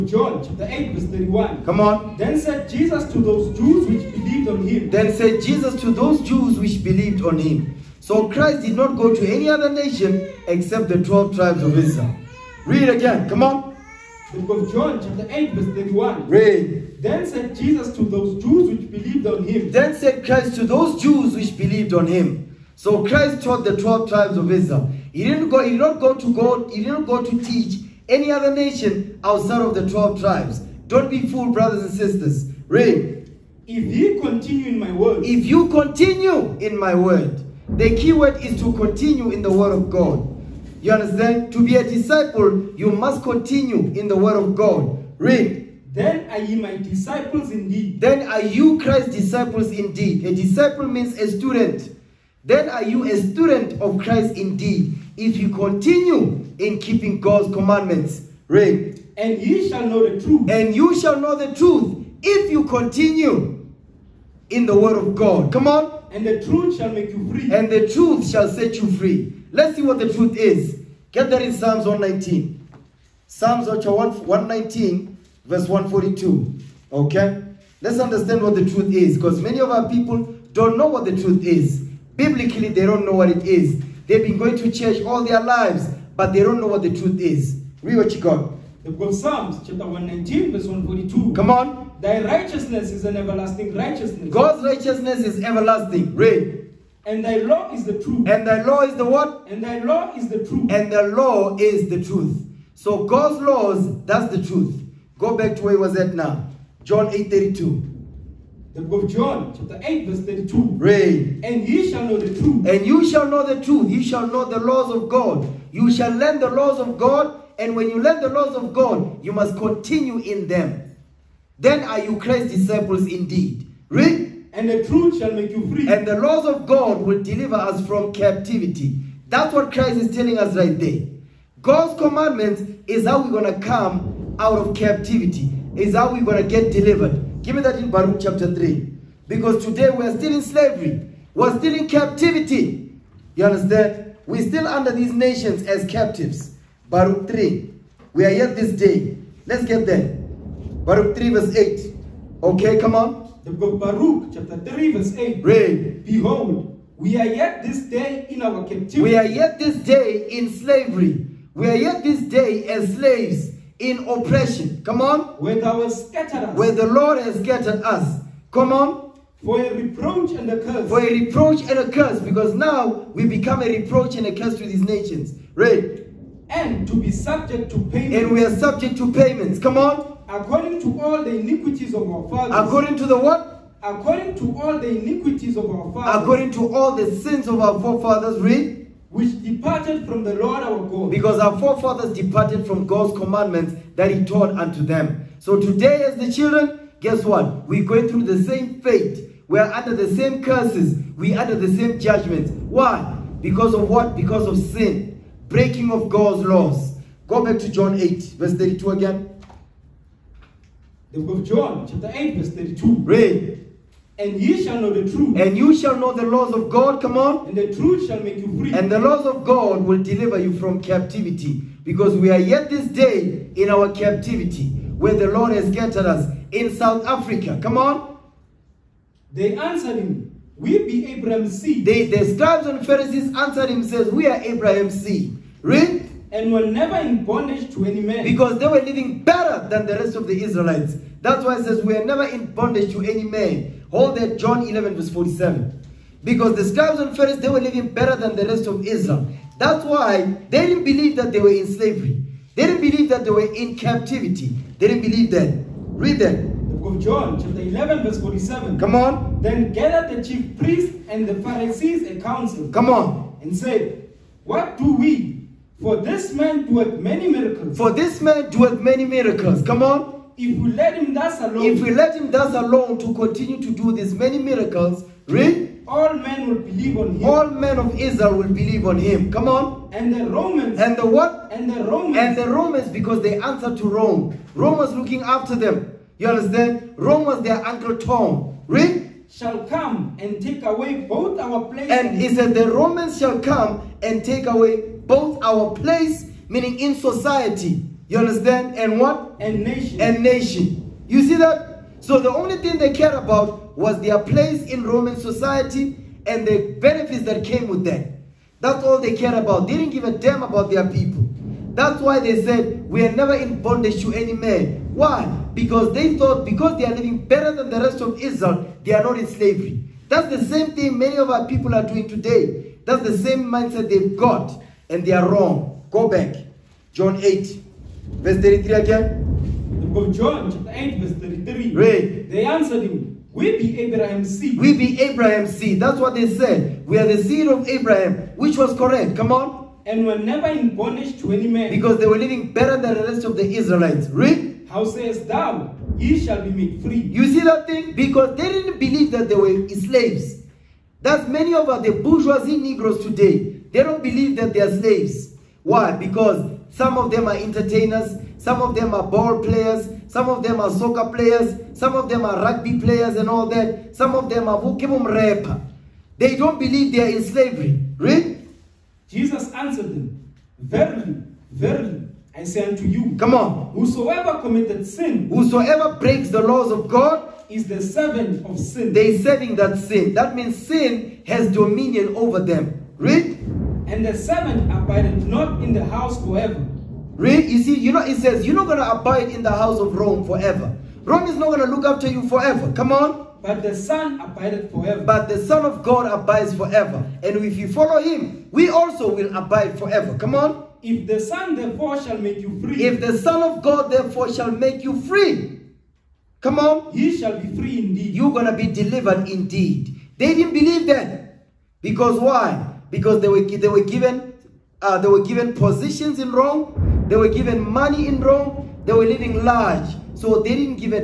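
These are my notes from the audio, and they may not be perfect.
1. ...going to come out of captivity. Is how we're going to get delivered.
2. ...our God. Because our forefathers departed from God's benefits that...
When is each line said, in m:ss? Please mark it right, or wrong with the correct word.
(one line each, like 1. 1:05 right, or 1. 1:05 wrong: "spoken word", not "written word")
1. 2:13 right
2. 3:10 wrong: "commandments", not "benefits".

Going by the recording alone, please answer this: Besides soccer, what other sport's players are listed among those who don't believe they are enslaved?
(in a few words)
rugby.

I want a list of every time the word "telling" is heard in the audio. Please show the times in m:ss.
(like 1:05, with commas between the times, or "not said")
2:10.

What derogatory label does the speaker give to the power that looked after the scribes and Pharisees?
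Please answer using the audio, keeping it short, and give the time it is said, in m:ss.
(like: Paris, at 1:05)
uncle Tom, at 4:46.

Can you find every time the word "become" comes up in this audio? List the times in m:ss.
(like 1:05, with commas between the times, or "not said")
2:53.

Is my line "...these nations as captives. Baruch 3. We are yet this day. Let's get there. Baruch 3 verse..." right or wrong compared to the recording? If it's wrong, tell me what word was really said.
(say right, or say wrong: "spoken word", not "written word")
right.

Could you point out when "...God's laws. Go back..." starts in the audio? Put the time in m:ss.
3:26.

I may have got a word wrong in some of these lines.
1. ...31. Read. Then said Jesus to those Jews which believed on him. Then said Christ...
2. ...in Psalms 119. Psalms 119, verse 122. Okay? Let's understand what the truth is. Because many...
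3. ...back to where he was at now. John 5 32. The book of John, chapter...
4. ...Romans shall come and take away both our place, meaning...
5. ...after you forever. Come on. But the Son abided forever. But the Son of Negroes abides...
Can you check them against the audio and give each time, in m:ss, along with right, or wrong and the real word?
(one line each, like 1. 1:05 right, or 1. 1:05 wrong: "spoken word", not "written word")
1. 0:15 right
2. 1:11 wrong: "142", not "122"
3. 1:45 wrong: "8", not "5"
4. 4:52 right
5. 6:31 wrong: "God", not "Negroes".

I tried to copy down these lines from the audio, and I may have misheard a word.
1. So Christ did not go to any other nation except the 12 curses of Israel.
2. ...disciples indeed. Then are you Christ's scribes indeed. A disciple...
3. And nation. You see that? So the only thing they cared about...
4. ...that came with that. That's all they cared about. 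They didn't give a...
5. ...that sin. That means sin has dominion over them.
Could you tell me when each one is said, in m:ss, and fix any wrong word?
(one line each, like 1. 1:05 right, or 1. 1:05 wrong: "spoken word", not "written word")
1. 0:07 wrong: "tribes", not "curses"
2. 0:46 wrong: "disciples", not "scribes"
3. 5:00 right
4. 5:07 right
5. 6:19 right.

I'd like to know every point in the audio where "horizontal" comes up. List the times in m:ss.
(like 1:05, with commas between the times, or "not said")
not said.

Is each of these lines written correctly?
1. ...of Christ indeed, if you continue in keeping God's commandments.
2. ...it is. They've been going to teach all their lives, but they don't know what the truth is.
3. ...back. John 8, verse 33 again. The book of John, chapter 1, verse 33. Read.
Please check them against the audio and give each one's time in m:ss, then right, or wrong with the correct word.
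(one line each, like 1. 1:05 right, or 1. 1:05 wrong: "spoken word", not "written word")
1. 0:53 right
2. 1:23 wrong: "church", not "teach"
3. 5:26 wrong: "8", not "1".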